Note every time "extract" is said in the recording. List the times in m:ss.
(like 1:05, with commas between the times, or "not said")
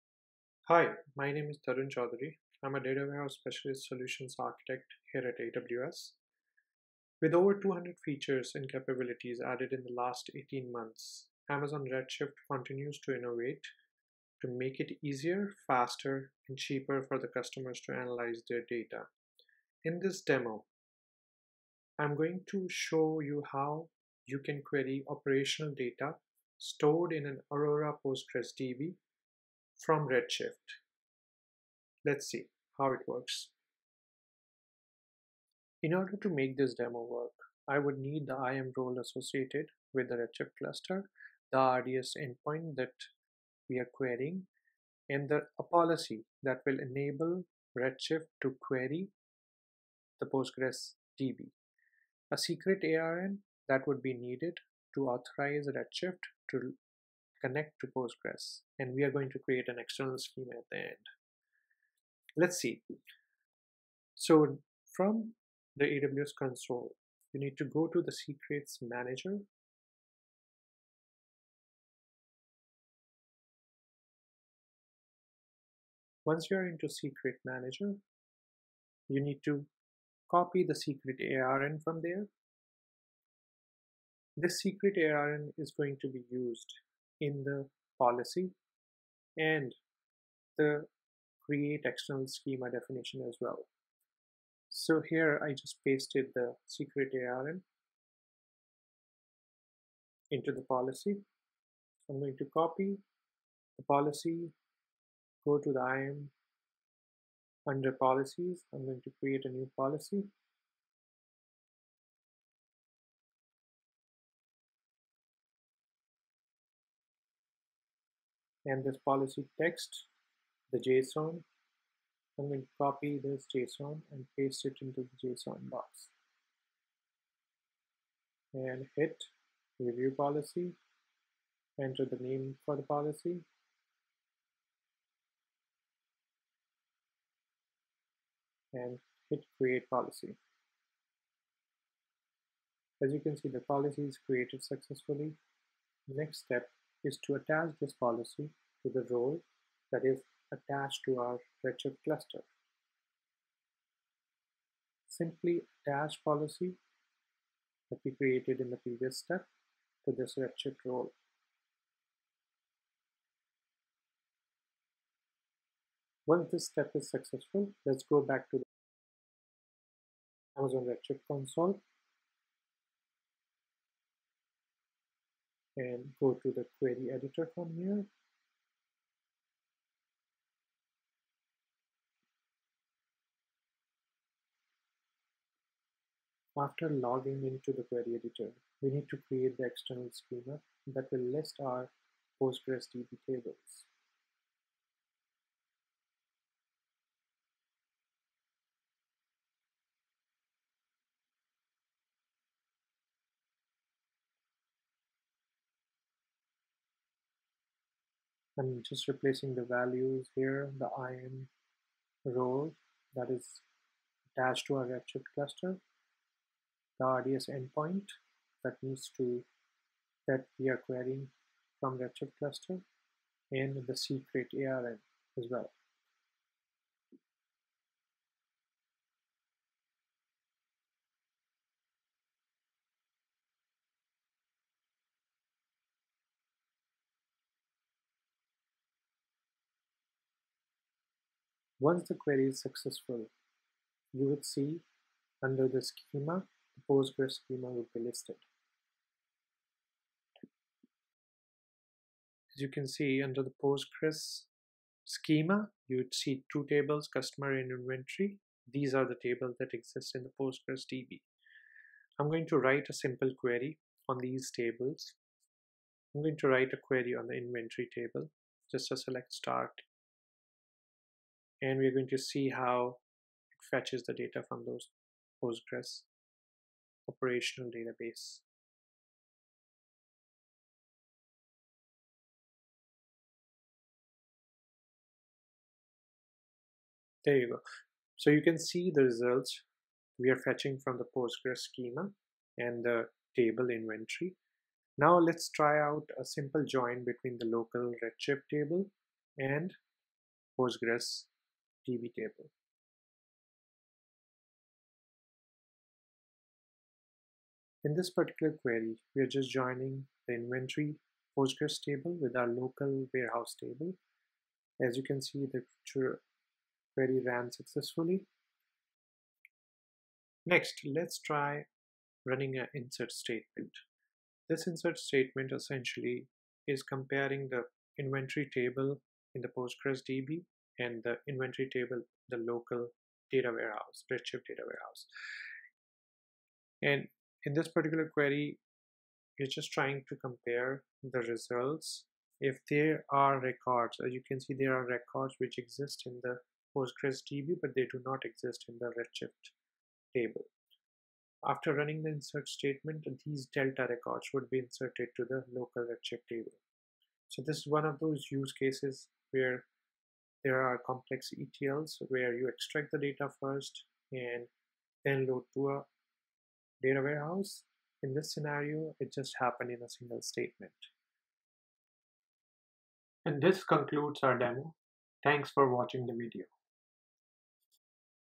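6:02.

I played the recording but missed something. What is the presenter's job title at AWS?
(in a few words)
data warehouse specialist solutions architect.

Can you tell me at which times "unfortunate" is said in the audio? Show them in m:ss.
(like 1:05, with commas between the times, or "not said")
not said.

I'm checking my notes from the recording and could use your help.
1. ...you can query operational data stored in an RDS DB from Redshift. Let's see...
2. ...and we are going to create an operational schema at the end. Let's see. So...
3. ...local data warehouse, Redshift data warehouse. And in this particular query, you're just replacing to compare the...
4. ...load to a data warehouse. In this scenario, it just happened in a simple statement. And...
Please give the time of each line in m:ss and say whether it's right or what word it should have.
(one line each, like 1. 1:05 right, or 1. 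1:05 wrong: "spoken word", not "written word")
1. 0:24 wrong: "Aurora", not "RDS"
2. 0:58 wrong: "external", not "operational"
3. 5:32 wrong: "trying", not "replacing"
4. 6:05 wrong: "single", not "simple".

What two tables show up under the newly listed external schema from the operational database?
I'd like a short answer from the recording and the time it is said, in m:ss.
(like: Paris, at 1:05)
customer and inventory, at 4:17.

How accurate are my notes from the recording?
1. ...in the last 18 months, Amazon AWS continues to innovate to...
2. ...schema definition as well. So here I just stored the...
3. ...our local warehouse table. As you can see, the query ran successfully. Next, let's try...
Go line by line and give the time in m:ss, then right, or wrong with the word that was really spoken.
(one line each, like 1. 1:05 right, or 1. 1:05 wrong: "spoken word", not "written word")
1. 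0:09 wrong: "Redshift", not "AWS"
2. 1:32 wrong: "pasted", not "stored"
3. 5:12 right.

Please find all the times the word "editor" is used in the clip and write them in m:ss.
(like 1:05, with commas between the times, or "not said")
2:57, 3:08.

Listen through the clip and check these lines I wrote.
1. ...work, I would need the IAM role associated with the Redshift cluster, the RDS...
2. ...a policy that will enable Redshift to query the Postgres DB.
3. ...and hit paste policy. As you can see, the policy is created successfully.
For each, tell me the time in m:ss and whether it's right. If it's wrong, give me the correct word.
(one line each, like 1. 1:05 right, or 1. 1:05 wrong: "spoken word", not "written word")
1. 0:37 right
2. 0:45 right
3. 2:18 wrong: "create", not "paste".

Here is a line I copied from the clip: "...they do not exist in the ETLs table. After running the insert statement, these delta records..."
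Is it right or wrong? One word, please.
wrong.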